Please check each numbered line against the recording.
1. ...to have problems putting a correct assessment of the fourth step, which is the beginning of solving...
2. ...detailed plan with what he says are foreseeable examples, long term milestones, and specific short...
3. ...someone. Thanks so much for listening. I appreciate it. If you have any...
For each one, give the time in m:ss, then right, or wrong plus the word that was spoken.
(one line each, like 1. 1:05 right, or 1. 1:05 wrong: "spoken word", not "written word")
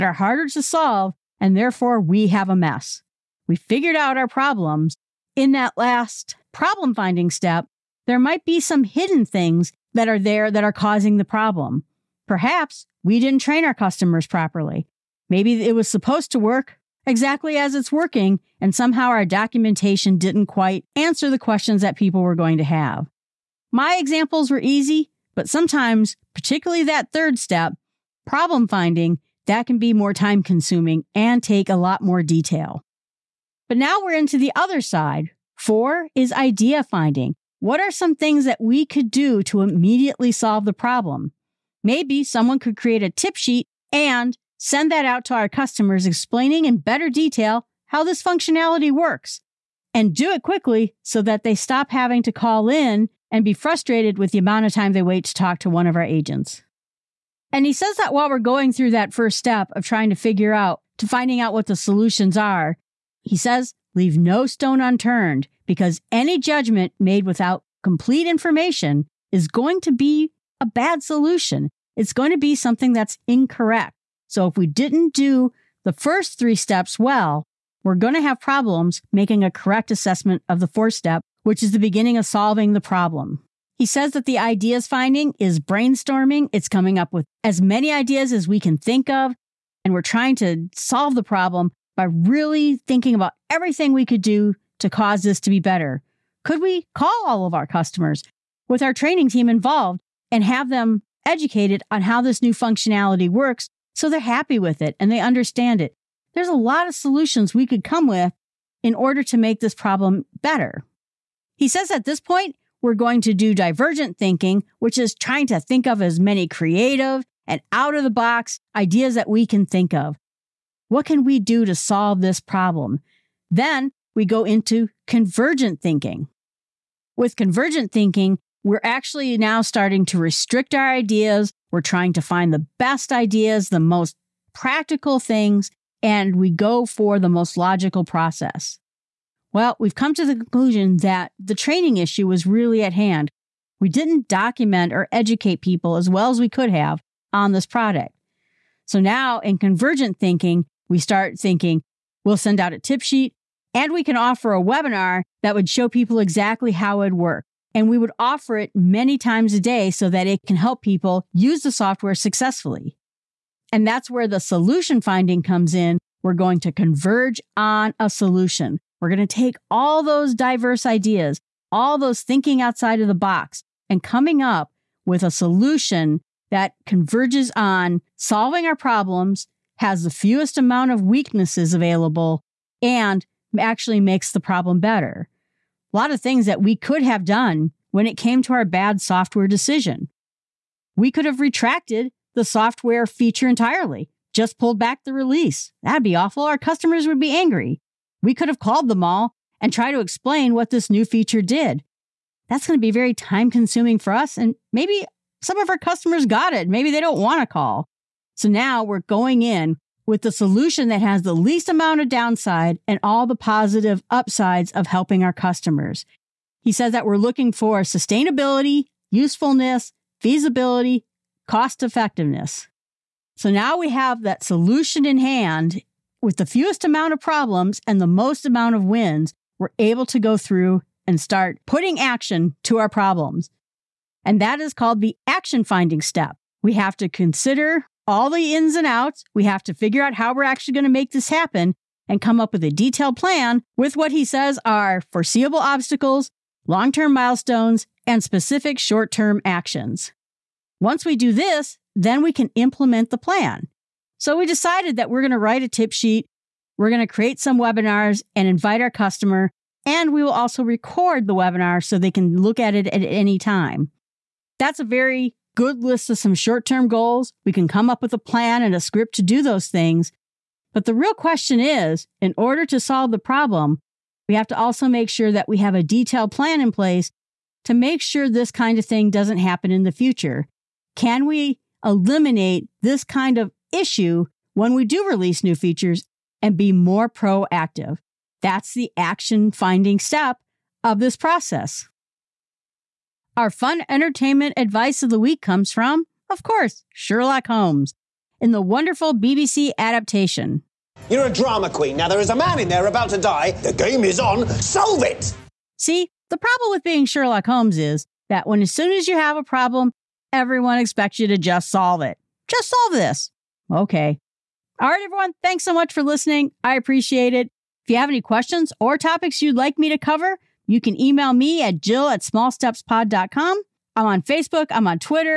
1. 1:18 wrong: "making", not "putting"
2. 4:02 wrong: "obstacles", not "examples"
3. 5:15 wrong: "everyone", not "someone".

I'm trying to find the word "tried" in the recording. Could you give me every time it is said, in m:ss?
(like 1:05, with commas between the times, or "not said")
3:19.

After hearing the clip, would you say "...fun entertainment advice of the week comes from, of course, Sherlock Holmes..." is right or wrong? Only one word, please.
right.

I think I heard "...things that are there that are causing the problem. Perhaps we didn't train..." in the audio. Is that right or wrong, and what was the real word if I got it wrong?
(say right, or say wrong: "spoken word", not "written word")
right.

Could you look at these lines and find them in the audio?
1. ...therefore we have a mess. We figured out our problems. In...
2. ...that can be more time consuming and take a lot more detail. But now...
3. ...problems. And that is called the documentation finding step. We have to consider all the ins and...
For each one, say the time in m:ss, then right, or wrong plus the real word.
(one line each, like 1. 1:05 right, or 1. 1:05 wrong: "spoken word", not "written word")
1. 0:01 right
2. 0:29 right
3. 3:52 wrong: "action", not "documentation".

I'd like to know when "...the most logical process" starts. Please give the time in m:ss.
2:17.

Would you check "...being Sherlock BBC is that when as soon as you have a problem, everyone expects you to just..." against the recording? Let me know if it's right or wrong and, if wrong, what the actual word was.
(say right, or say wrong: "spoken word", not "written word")
wrong: "Holmes", not "BBC".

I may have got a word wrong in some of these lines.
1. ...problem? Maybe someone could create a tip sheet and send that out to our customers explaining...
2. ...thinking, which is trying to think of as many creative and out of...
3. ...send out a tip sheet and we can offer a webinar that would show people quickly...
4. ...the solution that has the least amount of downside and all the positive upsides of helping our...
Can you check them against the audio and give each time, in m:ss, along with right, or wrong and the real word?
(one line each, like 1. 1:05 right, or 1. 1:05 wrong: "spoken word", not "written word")
1. 0:40 right
2. 1:54 right
3. 2:32 wrong: "exactly", not "quickly"
4. 3:30 right.